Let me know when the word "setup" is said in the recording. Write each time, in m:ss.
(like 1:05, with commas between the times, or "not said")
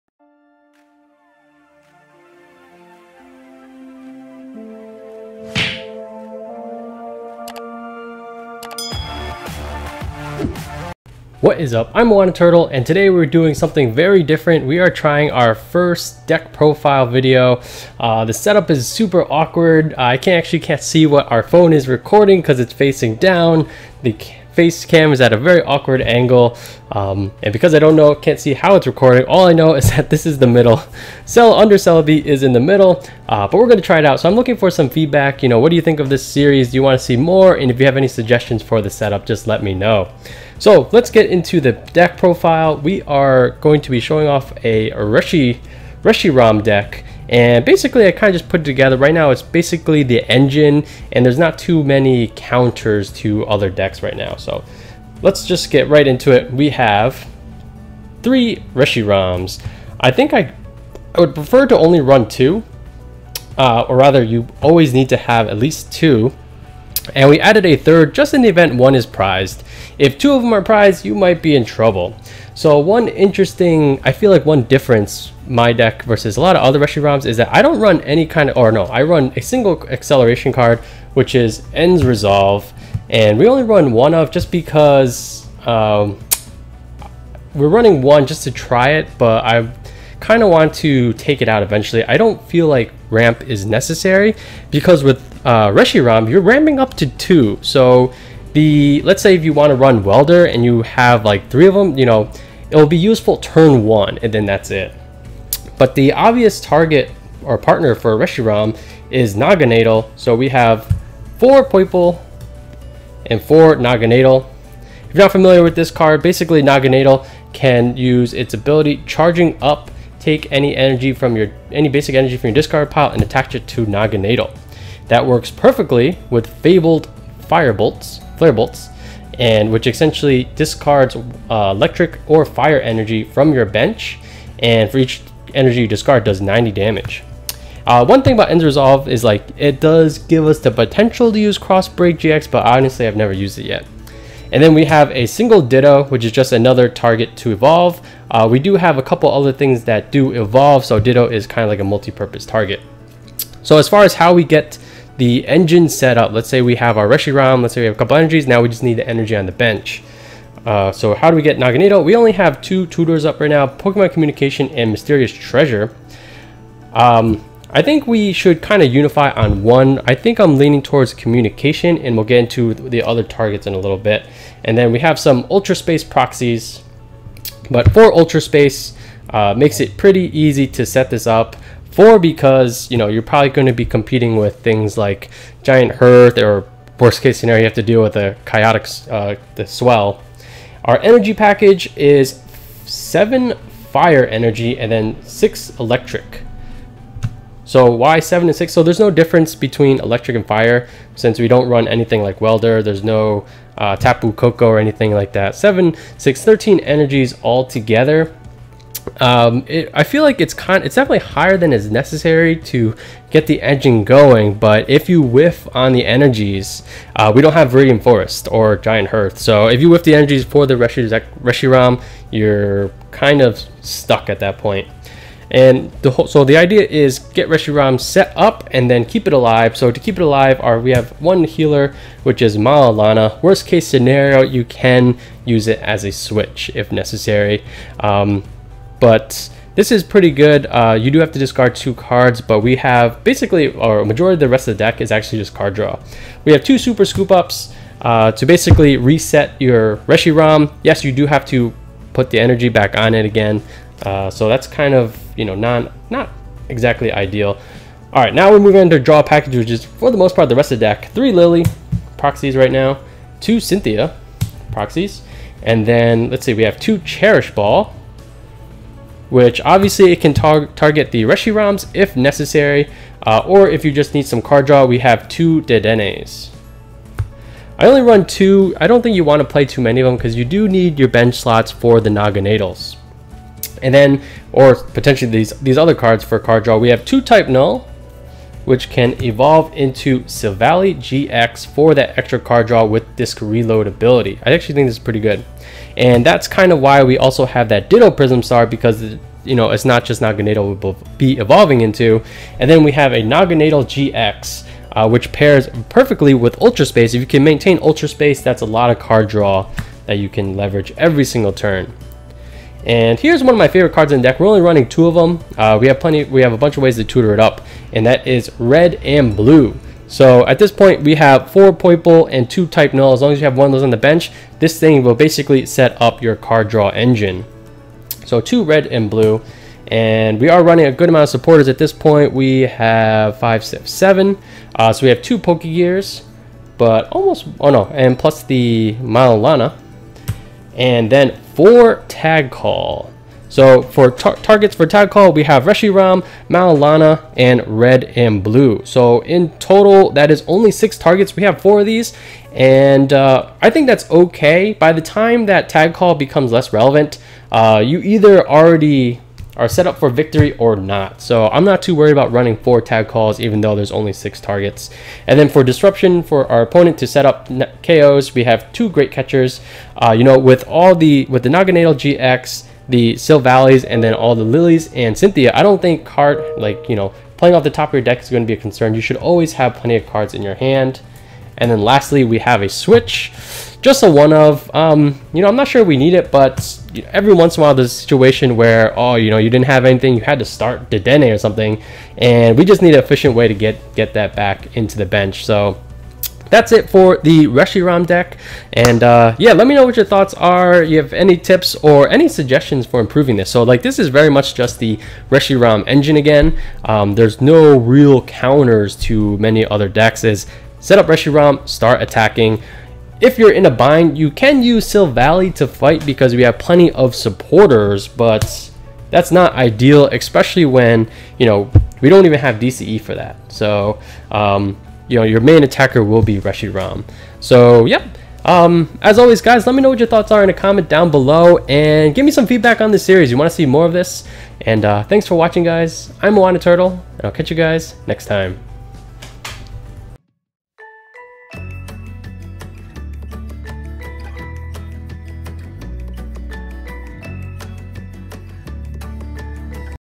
0:18, 0:38.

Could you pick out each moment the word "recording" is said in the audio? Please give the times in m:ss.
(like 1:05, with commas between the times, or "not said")
0:21, 0:28.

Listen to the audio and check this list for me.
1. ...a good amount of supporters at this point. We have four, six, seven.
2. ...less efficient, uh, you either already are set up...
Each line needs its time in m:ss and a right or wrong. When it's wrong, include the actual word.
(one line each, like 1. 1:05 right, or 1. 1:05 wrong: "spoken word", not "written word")
1. 5:30 wrong: "five", not "four"
2. 5:56 wrong: "relevant", not "efficient".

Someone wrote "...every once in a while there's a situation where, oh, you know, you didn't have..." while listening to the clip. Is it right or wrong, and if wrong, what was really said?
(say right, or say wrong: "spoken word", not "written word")
right.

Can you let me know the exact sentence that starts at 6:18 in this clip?
You should always have plenty of cards in your hand.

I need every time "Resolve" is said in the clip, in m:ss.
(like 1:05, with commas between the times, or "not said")
1:22, 2:18.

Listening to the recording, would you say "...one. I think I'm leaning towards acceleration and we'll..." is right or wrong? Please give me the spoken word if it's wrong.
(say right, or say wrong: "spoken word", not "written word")
wrong: "communication", not "acceleration".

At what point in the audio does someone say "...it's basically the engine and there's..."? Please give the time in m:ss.
0:49.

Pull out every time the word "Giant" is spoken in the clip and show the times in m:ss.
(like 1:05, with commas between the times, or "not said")
3:05, 3:38.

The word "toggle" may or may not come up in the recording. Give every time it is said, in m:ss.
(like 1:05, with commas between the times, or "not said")
not said.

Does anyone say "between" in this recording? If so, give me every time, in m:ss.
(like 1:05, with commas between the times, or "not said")
3:19.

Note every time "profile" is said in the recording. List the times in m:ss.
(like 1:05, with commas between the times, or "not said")
0:16, 0:42.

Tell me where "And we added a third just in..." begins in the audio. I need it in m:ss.
1:07.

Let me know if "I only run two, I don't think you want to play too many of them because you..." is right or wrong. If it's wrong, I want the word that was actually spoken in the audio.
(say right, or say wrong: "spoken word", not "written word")
right.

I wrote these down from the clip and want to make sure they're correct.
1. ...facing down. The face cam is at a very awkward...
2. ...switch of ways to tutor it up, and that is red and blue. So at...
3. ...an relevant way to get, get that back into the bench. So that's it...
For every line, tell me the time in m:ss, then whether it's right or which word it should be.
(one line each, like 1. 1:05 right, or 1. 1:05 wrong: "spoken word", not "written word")
1. 0:22 right
2. 5:16 wrong: "bunch", not "switch"
3. 6:32 wrong: "efficient", not "relevant".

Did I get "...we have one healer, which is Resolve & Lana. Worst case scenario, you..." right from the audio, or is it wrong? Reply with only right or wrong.
wrong.